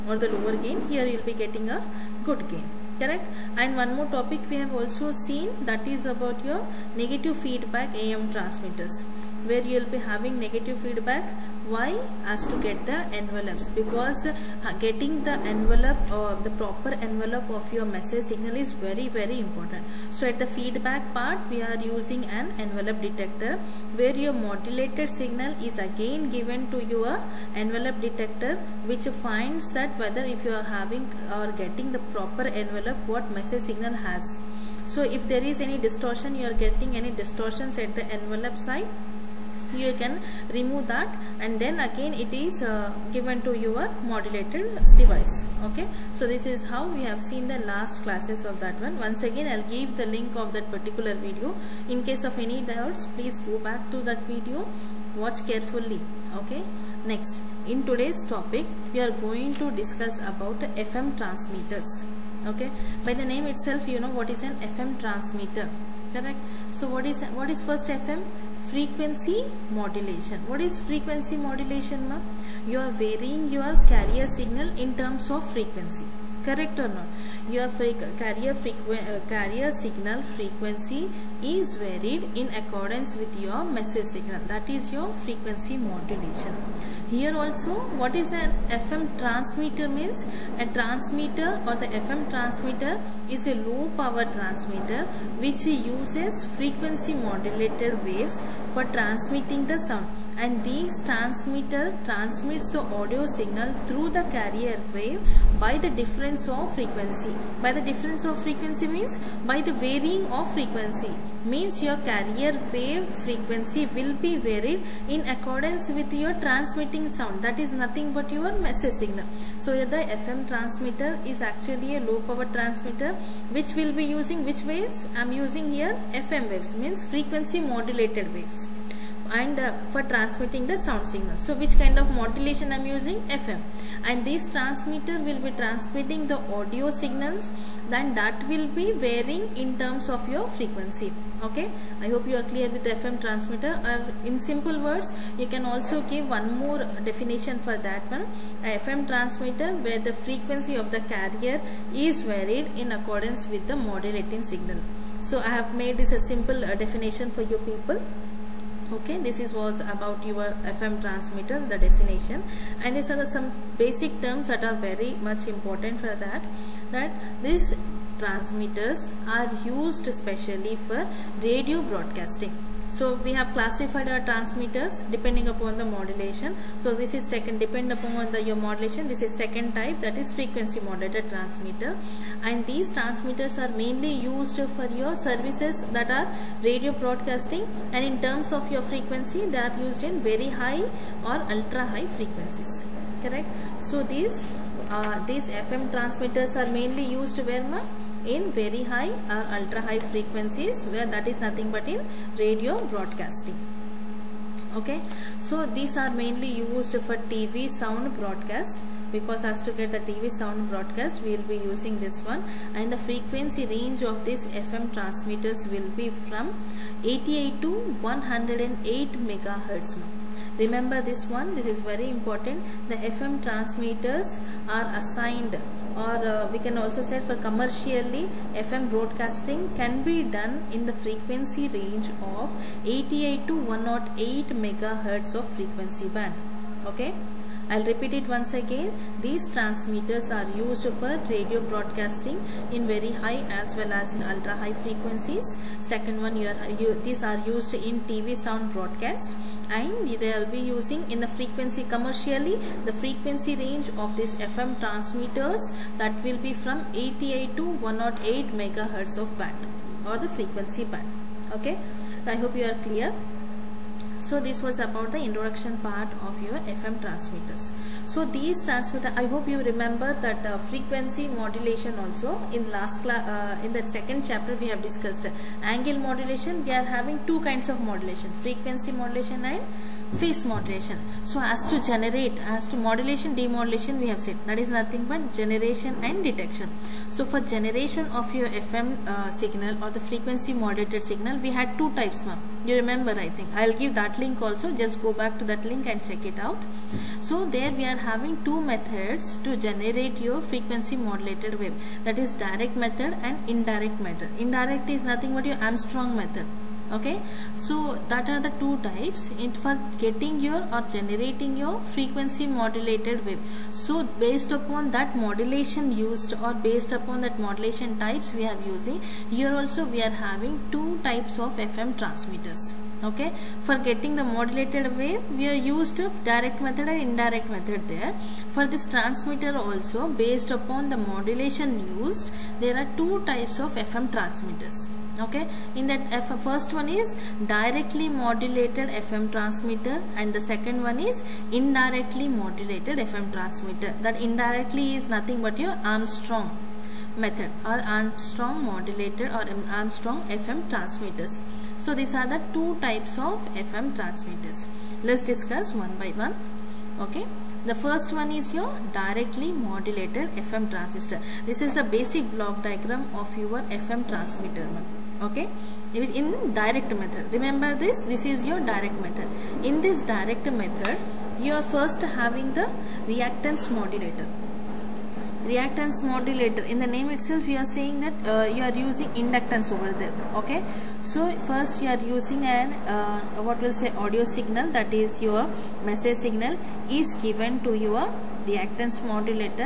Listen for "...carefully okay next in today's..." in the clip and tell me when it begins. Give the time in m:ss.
0:55.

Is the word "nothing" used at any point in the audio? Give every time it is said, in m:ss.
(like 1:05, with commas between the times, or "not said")
1:57, 3:21, 4:44, 5:05, 5:45.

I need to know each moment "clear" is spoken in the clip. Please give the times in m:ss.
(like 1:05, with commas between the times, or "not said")
2:22, 4:22.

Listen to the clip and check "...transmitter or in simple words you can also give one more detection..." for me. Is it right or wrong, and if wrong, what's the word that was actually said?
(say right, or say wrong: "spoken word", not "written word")
wrong: "definition", not "detection".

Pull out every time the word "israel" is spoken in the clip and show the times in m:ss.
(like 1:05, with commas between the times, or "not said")
not said.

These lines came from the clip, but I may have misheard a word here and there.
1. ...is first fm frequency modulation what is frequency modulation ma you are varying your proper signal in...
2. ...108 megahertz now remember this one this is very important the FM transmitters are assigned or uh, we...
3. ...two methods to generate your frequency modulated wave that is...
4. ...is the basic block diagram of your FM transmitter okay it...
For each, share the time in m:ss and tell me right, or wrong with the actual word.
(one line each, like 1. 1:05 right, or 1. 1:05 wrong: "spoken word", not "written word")
1. 1:07 wrong: "carrier", not "proper"
2. 3:37 right
3. 4:58 right
4. 6:01 right.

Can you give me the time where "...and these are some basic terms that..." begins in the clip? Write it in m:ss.
2:42.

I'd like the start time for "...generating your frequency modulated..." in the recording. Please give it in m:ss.
5:10.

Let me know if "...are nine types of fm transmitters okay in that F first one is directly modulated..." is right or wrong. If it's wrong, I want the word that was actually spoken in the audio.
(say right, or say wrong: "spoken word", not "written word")
wrong: "two", not "nine".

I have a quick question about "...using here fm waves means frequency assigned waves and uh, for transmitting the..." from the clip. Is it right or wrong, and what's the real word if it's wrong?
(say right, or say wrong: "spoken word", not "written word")
wrong: "modulated", not "assigned".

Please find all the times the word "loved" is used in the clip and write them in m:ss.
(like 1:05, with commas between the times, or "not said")
not said.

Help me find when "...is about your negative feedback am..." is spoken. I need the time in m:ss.
0:05.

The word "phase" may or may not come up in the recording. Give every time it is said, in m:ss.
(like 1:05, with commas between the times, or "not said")
4:40.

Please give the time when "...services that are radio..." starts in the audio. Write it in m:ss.
3:05.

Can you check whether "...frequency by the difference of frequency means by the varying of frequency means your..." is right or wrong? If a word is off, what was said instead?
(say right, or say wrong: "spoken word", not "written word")
right.